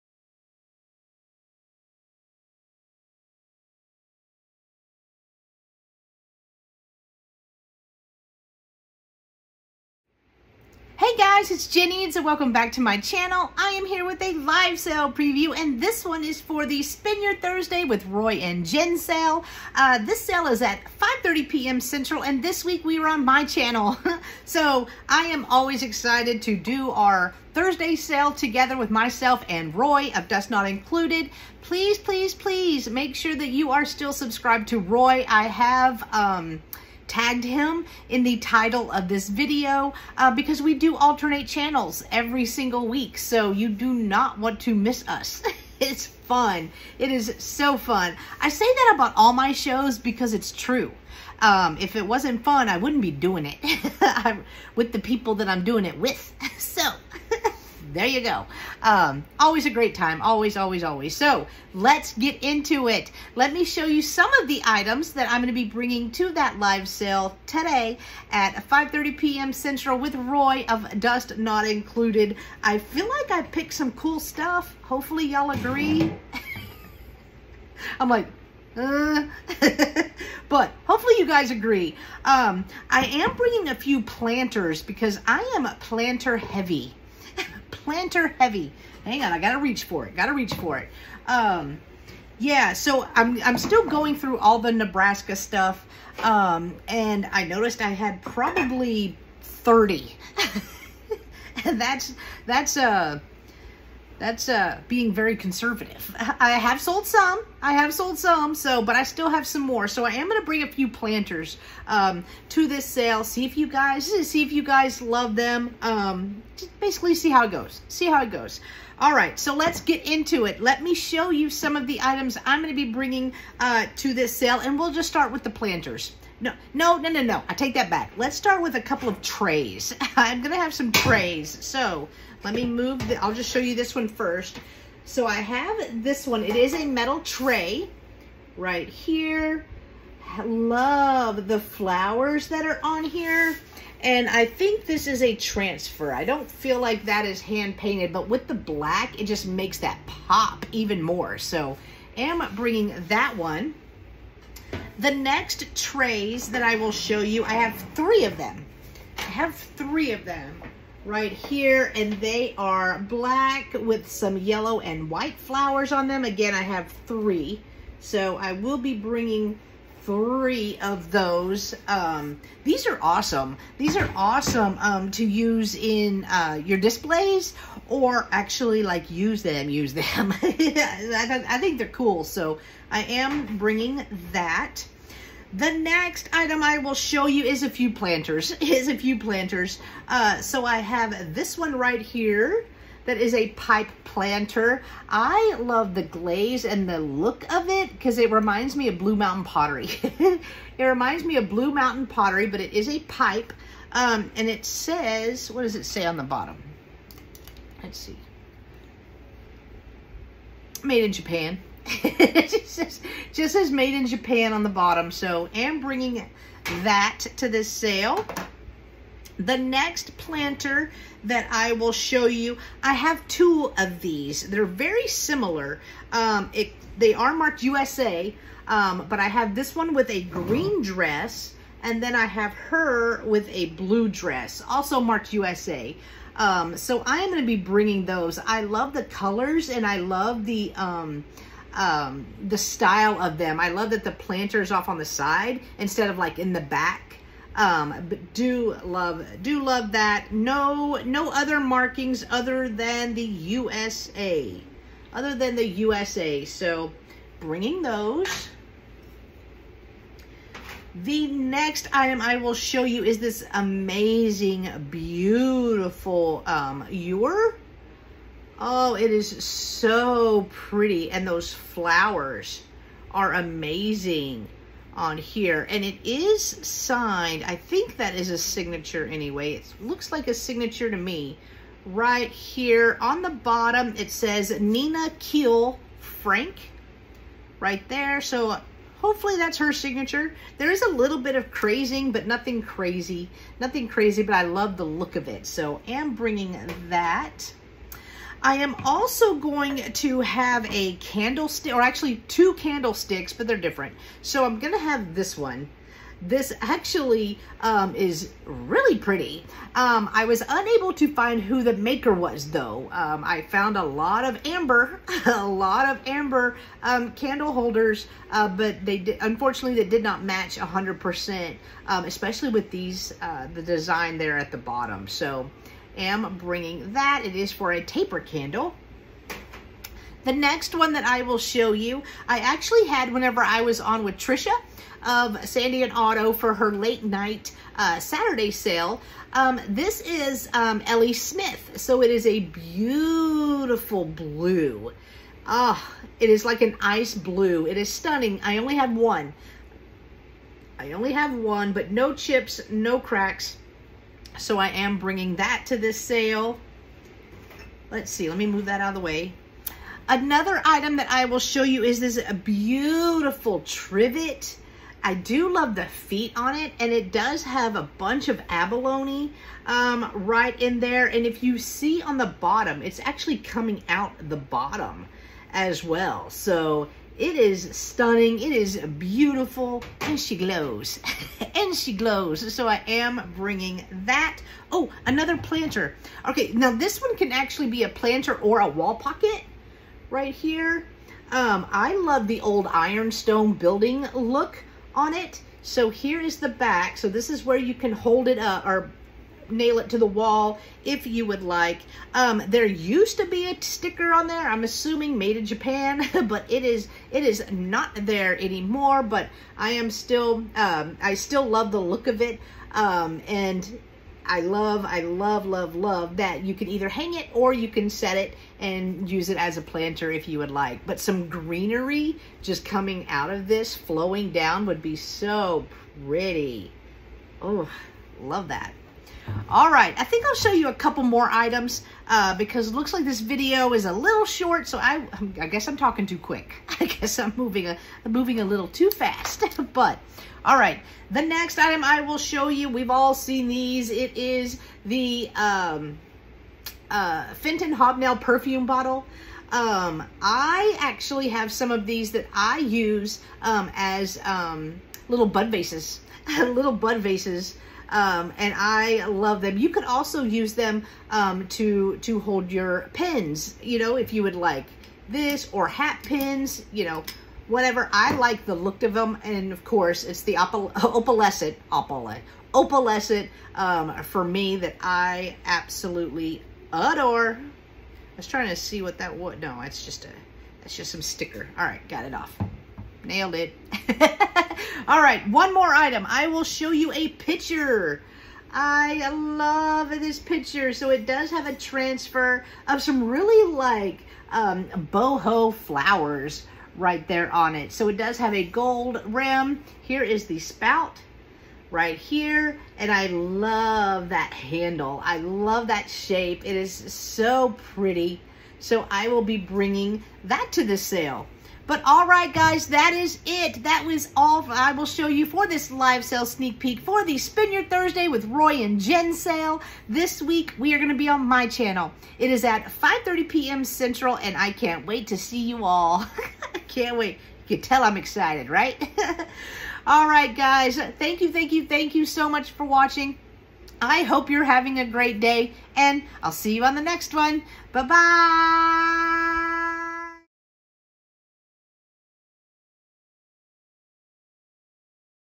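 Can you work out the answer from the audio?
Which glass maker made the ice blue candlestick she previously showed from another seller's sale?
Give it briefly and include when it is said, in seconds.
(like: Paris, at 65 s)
L.E. Smith, at 340 s.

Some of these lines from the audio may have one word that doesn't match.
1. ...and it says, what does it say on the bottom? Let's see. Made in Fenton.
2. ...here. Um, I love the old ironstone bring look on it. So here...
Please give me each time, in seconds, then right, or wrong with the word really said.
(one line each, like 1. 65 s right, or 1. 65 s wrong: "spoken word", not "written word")
1. 204 s wrong: "Japan", not "Fenton"
2. 390 s wrong: "building", not "bring".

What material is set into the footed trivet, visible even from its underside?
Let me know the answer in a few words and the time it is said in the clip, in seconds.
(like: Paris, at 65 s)
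Abalone, at 368 s.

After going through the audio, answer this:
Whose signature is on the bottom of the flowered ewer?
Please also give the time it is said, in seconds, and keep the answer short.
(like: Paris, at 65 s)
Nina Keel Frank, at 284 s.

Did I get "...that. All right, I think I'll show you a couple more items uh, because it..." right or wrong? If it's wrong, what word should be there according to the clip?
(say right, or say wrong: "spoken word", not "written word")
right.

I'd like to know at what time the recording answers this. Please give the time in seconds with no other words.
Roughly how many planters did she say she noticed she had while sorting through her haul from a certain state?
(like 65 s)
99 s.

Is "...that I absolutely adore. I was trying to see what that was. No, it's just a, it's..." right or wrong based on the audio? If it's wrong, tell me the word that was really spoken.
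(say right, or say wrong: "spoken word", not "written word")
right.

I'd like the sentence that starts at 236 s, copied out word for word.
Um, so I am going to be bringing those.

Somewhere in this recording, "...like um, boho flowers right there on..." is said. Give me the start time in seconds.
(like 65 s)
493 s.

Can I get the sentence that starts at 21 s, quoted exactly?
Central and this week we are on my channel.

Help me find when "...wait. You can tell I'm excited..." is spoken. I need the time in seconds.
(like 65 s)
526 s.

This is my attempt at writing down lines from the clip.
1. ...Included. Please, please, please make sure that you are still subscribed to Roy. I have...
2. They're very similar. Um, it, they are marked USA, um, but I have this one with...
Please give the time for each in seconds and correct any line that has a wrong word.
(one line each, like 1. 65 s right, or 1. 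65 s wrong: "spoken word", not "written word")
1. 30 s right
2. 224 s right.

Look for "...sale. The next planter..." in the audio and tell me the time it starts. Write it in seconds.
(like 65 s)
217 s.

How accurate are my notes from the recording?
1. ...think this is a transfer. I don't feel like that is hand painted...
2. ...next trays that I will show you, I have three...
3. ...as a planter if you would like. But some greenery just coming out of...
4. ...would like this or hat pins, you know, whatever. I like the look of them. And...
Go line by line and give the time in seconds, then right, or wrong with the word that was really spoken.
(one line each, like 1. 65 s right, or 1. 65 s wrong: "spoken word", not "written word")
1. 144 s right
2. 155 s right
3. 419 s right
4. 464 s right.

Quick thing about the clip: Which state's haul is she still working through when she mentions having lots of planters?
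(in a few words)
Nebraska.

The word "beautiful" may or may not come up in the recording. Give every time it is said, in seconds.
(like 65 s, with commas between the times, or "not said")
264 s, 342 s, 362 s, 378 s.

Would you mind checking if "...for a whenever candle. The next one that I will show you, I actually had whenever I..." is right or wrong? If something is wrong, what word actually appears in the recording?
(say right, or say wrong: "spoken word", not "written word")
wrong: "taper", not "whenever".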